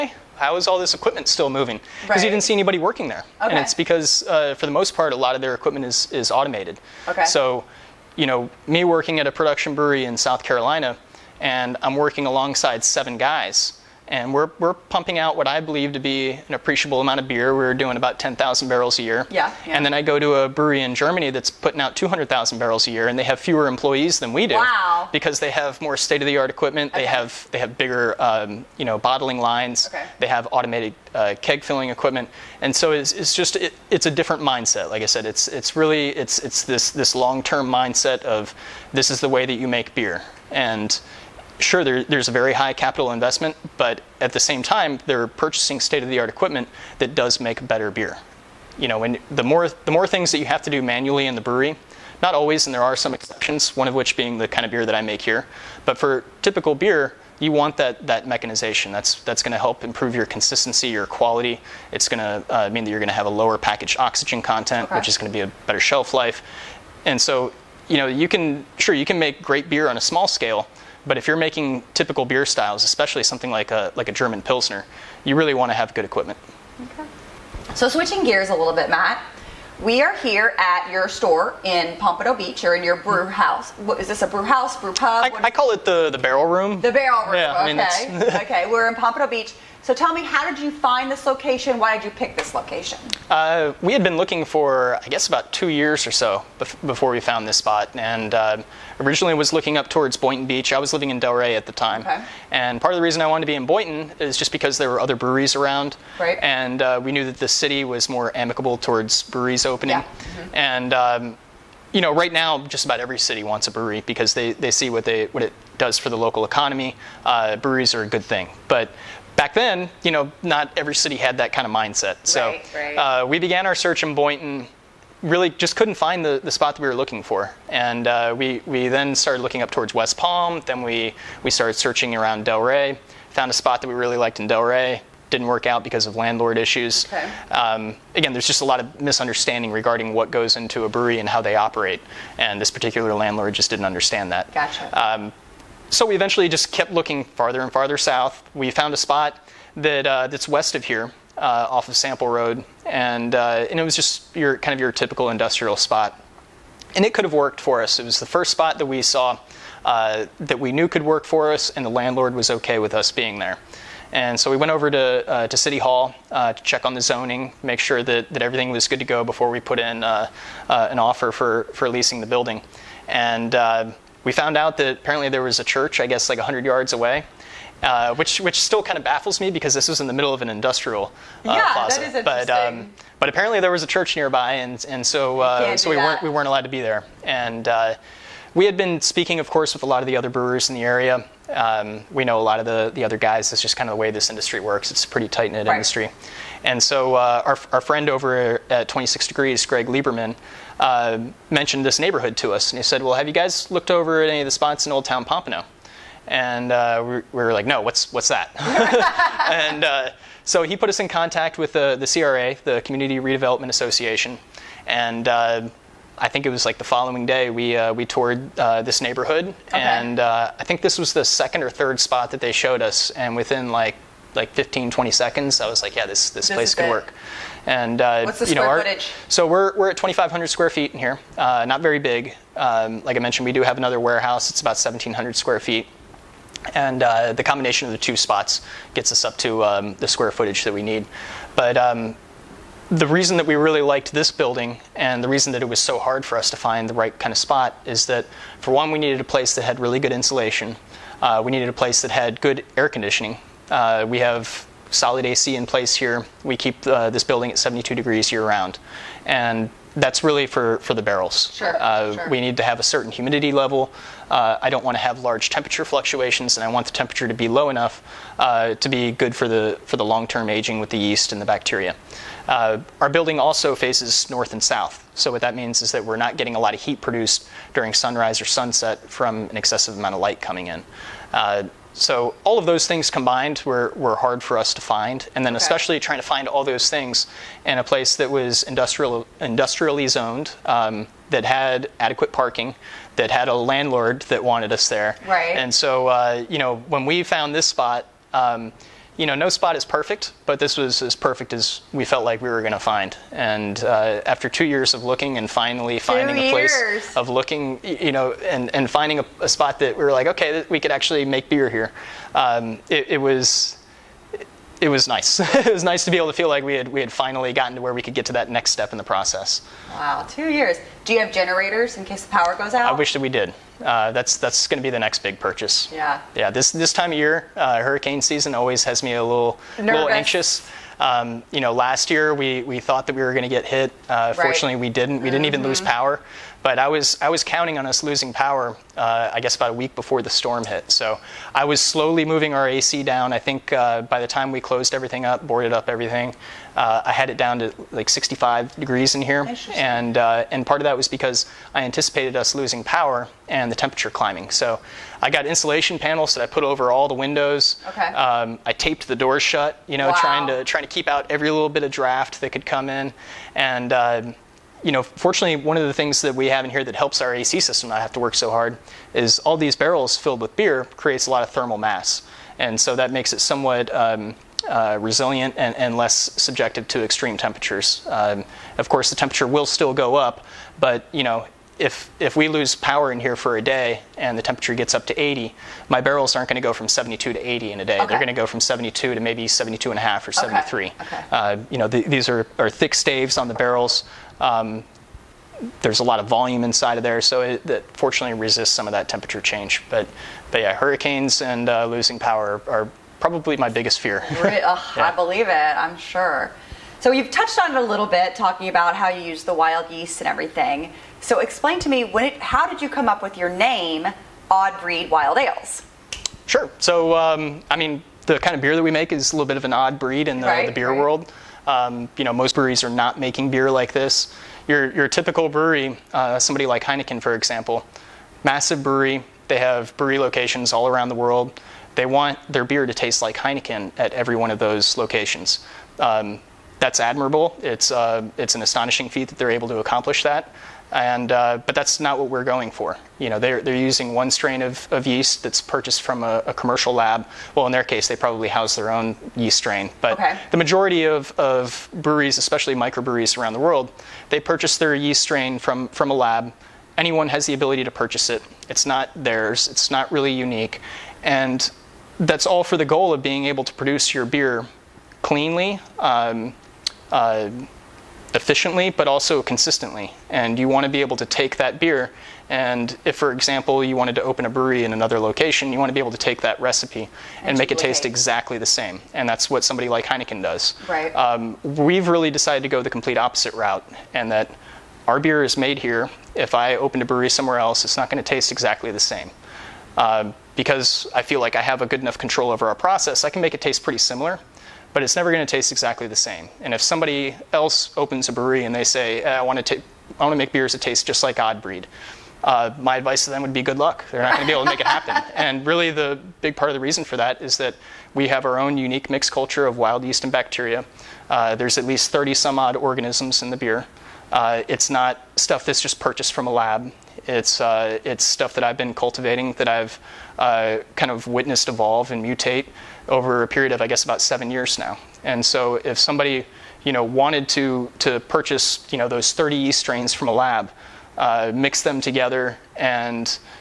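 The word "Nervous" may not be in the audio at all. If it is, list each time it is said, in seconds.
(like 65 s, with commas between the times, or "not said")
329 s.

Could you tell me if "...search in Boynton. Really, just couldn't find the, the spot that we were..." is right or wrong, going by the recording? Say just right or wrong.
right.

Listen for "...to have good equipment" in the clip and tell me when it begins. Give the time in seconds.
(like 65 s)
75 s.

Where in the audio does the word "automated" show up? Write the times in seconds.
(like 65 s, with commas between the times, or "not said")
6 s, 30 s.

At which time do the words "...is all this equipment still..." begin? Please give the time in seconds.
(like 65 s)
0 s.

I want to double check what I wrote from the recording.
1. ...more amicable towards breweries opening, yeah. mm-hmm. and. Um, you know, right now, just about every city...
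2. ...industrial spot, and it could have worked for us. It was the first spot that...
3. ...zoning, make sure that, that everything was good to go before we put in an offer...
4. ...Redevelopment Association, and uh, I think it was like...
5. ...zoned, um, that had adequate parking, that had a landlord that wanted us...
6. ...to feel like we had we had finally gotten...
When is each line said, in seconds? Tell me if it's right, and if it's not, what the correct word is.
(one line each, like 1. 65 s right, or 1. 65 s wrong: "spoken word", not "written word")
1. 108 s right
2. 155 s right
3. 167 s right
4. 213 s right
5. 290 s right
6. 316 s right.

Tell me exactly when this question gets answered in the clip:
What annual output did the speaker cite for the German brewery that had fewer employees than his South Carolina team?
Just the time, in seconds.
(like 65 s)
21 s.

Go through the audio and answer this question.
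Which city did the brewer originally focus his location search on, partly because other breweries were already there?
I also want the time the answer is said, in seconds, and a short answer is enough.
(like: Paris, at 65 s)
Boynton Beach, at 100 s.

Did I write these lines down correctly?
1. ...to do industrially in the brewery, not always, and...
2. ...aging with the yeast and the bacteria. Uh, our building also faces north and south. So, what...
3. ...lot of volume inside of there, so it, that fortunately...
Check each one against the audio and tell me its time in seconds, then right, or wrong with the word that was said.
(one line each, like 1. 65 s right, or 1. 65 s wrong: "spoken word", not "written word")
1. 50 s wrong: "manually", not "industrially"
2. 270 s right
3. 396 s right.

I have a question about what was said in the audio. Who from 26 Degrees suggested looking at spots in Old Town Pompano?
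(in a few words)
Greg Lieberman.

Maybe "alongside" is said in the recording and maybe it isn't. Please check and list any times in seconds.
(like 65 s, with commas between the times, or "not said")
12 s.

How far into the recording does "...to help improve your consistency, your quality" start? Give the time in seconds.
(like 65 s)
59 s.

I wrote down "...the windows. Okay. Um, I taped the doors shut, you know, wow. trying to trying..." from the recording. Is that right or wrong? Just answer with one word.
right.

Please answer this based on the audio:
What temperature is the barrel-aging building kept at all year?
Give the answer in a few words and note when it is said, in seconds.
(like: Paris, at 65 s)
72 degrees, at 257 s.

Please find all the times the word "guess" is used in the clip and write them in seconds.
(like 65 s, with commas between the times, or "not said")
95 s, 176 s, 339 s, 523 s.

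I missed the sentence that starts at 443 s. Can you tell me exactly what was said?
You know, they're, they're using one strain of, of yeast that's purchased from a, a, commercial lab.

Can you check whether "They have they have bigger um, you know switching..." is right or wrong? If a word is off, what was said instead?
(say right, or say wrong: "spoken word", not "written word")
wrong: "bottling", not "switching".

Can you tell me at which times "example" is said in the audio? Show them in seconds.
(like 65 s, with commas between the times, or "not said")
427 s, 473 s.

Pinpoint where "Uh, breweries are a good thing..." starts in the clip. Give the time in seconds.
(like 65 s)
117 s.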